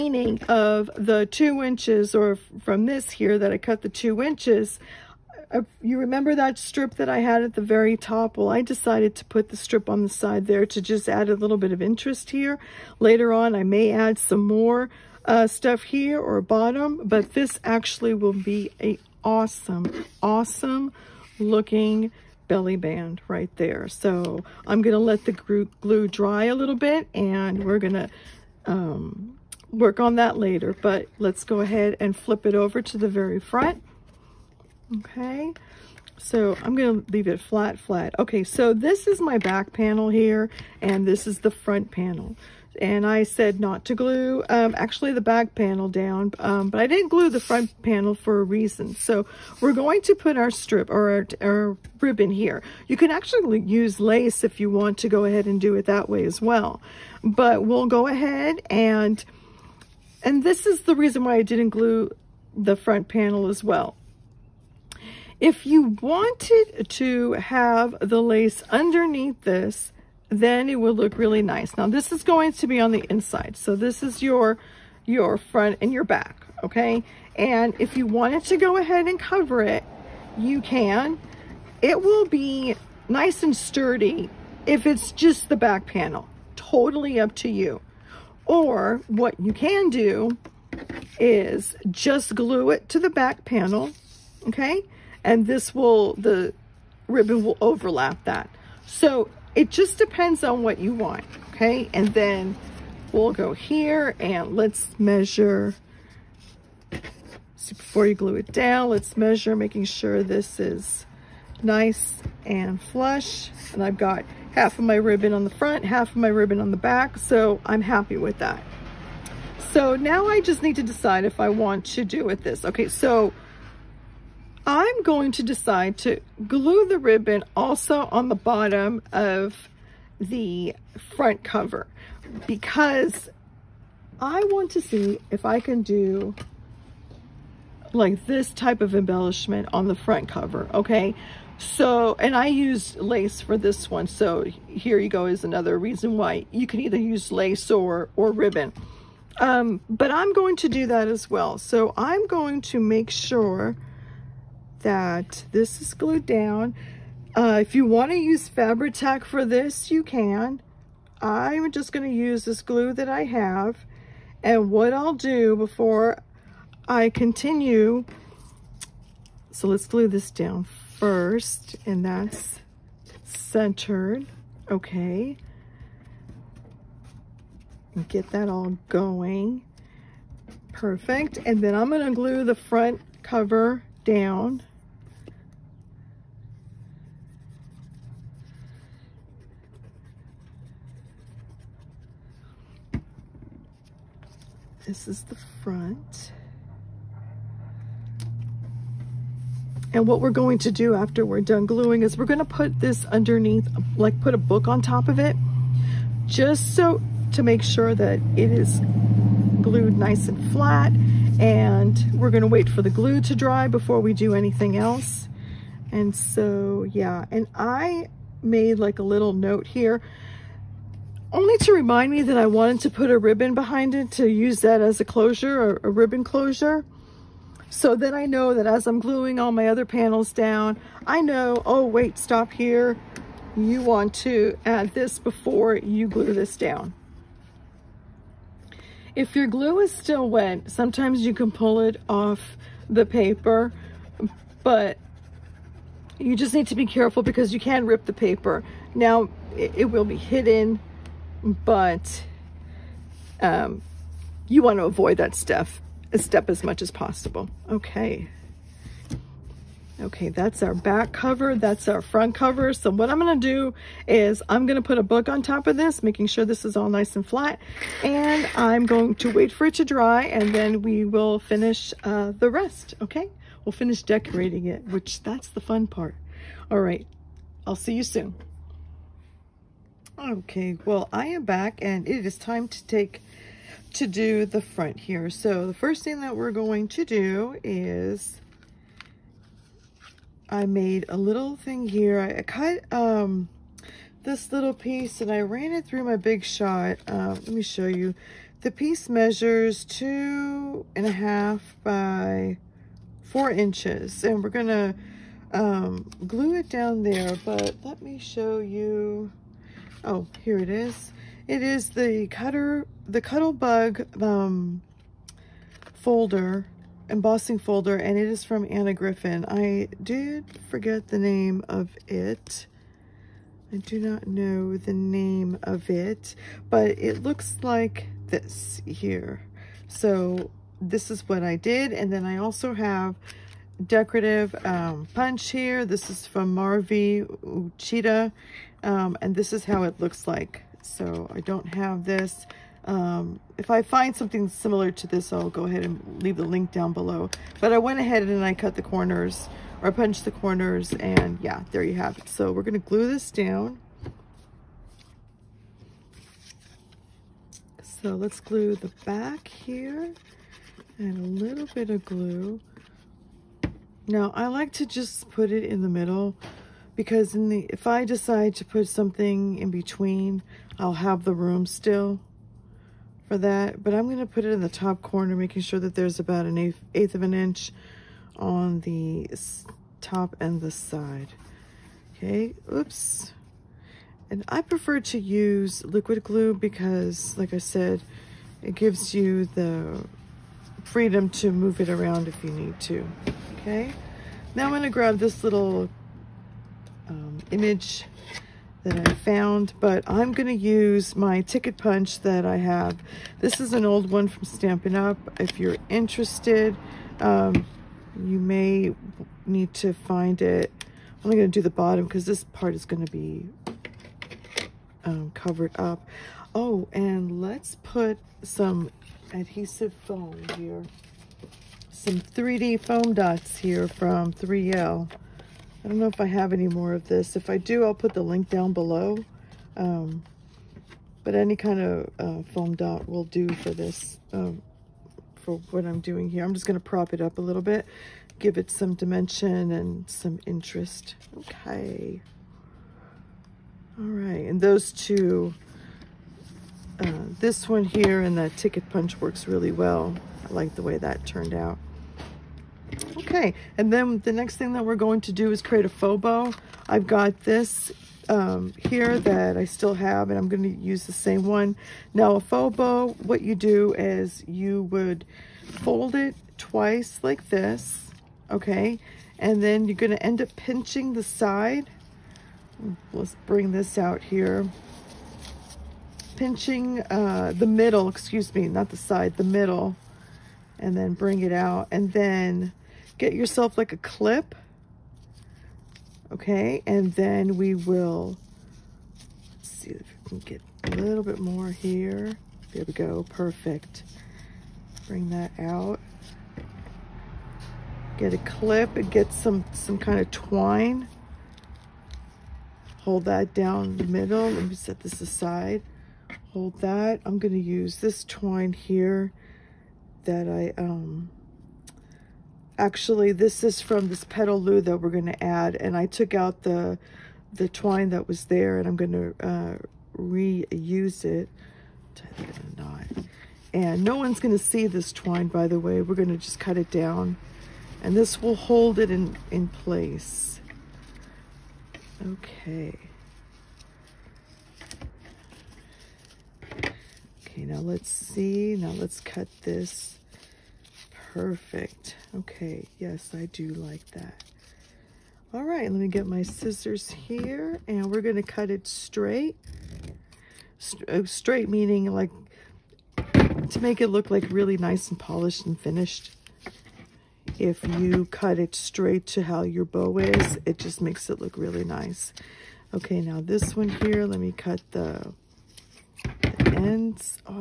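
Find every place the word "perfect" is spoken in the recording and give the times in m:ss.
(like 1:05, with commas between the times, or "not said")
3:00, 8:13, 9:01.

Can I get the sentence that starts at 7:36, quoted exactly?
I've got this um, here that I still have, and I'm going to use the same one.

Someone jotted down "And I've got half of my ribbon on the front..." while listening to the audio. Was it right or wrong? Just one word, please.
right.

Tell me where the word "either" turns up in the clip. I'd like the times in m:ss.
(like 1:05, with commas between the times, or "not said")
2:26.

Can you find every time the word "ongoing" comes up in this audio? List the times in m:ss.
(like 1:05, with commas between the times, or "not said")
not said.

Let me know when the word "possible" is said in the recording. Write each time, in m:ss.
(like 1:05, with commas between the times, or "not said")
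4:16.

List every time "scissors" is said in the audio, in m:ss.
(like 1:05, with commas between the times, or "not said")
9:06.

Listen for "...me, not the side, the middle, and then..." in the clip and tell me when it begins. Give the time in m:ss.
7:58.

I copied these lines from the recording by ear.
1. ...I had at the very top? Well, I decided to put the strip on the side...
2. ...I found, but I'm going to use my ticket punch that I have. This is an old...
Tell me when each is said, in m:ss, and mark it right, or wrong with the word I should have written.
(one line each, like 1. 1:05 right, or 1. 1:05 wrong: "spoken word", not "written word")
1. 0:07 right
2. 6:39 right.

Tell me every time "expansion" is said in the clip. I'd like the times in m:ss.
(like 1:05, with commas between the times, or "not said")
not said.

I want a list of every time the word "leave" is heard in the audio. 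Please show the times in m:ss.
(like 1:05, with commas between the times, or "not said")
0:37, 5:46.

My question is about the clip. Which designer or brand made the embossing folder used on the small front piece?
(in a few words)
Anna Griffin.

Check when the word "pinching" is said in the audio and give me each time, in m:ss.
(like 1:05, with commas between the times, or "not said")
7:50, 7:56.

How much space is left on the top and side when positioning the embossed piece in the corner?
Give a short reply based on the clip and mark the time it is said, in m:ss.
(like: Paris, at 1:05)
1/8 inch, at 6:16.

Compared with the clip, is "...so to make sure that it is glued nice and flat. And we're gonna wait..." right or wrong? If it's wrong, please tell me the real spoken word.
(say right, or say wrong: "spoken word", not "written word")
right.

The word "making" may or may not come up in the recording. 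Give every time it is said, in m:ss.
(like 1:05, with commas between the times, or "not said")
1:49, 4:26, 6:15.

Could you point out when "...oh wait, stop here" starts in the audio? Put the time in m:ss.
3:51.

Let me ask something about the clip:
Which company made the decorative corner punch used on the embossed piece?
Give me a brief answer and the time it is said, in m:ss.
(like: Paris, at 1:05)
Marvy Uchida, at 5:36.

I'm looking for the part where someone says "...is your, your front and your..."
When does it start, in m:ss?
1:14.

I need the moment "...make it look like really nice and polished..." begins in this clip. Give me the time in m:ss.
9:13.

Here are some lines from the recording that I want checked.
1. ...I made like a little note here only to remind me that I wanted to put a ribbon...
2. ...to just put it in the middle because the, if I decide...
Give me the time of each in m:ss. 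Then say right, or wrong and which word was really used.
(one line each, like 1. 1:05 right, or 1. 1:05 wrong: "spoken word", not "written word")
1. 3:37 right
2. 6:04 right.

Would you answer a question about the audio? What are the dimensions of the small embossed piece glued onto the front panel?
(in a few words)
2.5 by 4 inches.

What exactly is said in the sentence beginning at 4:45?
So the first thing that we're going to do is I made a little thing here.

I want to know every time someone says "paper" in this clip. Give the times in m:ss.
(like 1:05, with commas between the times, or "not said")
4:03, 4:08.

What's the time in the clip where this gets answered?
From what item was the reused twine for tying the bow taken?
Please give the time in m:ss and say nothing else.
8:34.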